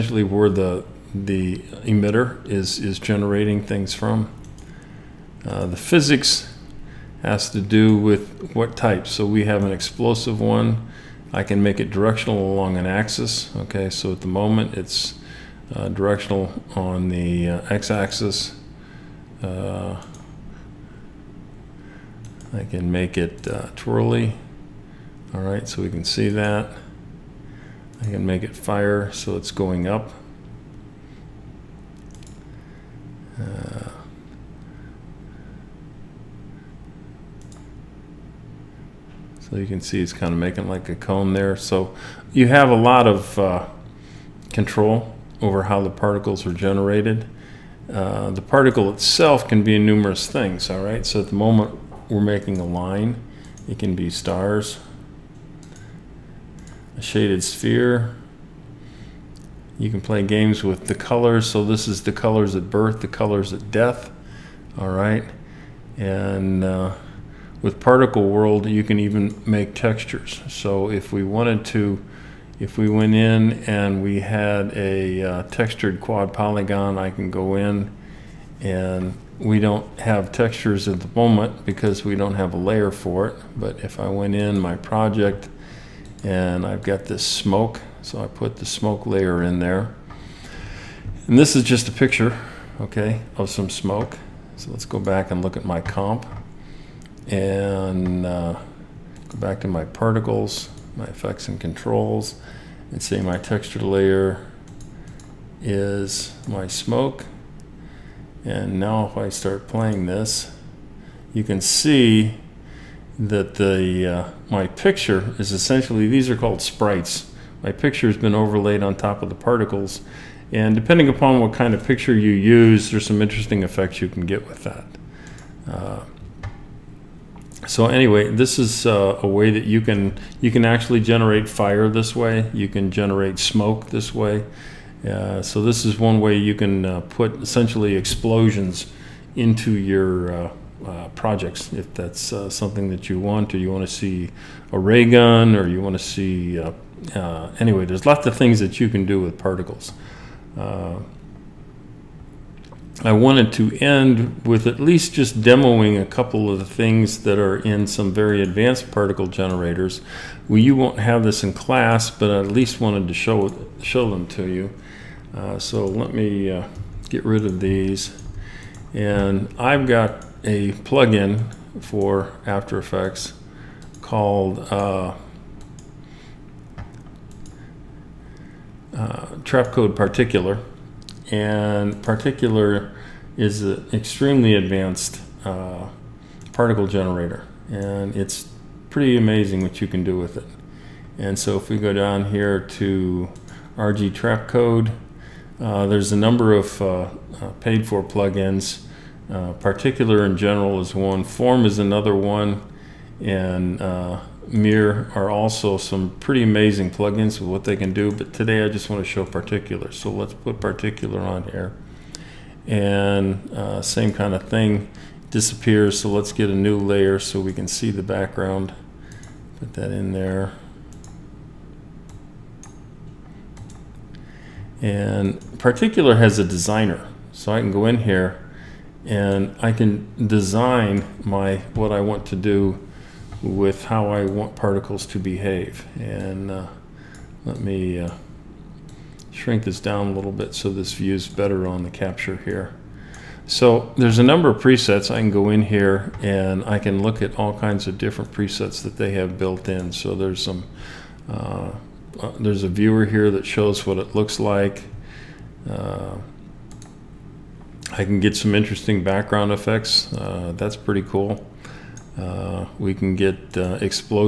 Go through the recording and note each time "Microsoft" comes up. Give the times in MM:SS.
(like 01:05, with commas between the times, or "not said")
not said.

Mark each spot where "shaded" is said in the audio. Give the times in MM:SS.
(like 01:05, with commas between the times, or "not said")
00:57.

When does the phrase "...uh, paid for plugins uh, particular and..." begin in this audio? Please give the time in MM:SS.
03:17.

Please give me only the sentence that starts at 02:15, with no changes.
Uh, so this is one way you can uh, put essentially explosions into your uh, uh, projects.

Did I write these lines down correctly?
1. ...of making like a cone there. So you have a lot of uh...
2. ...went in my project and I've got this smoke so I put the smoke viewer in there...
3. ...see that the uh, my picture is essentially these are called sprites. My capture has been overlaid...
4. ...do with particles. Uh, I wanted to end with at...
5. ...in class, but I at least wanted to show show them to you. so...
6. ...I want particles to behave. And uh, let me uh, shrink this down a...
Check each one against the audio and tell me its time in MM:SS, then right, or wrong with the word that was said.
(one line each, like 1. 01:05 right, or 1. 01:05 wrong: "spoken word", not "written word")
1. 00:40 right
2. 01:24 wrong: "layer", not "viewer"
3. 01:51 wrong: "picture", not "capture"
4. 02:29 right
5. 02:41 right
6. 03:54 right.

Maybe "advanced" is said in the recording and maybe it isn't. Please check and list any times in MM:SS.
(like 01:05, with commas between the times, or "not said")
02:38, 03:04.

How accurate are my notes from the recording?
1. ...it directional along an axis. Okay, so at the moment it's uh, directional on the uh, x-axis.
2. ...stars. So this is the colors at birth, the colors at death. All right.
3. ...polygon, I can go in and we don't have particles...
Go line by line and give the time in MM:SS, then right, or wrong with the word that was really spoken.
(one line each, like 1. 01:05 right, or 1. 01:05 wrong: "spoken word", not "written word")
1. 00:11 right
2. 01:00 wrong: "colors", not "stars"
3. 01:16 wrong: "textures", not "particles".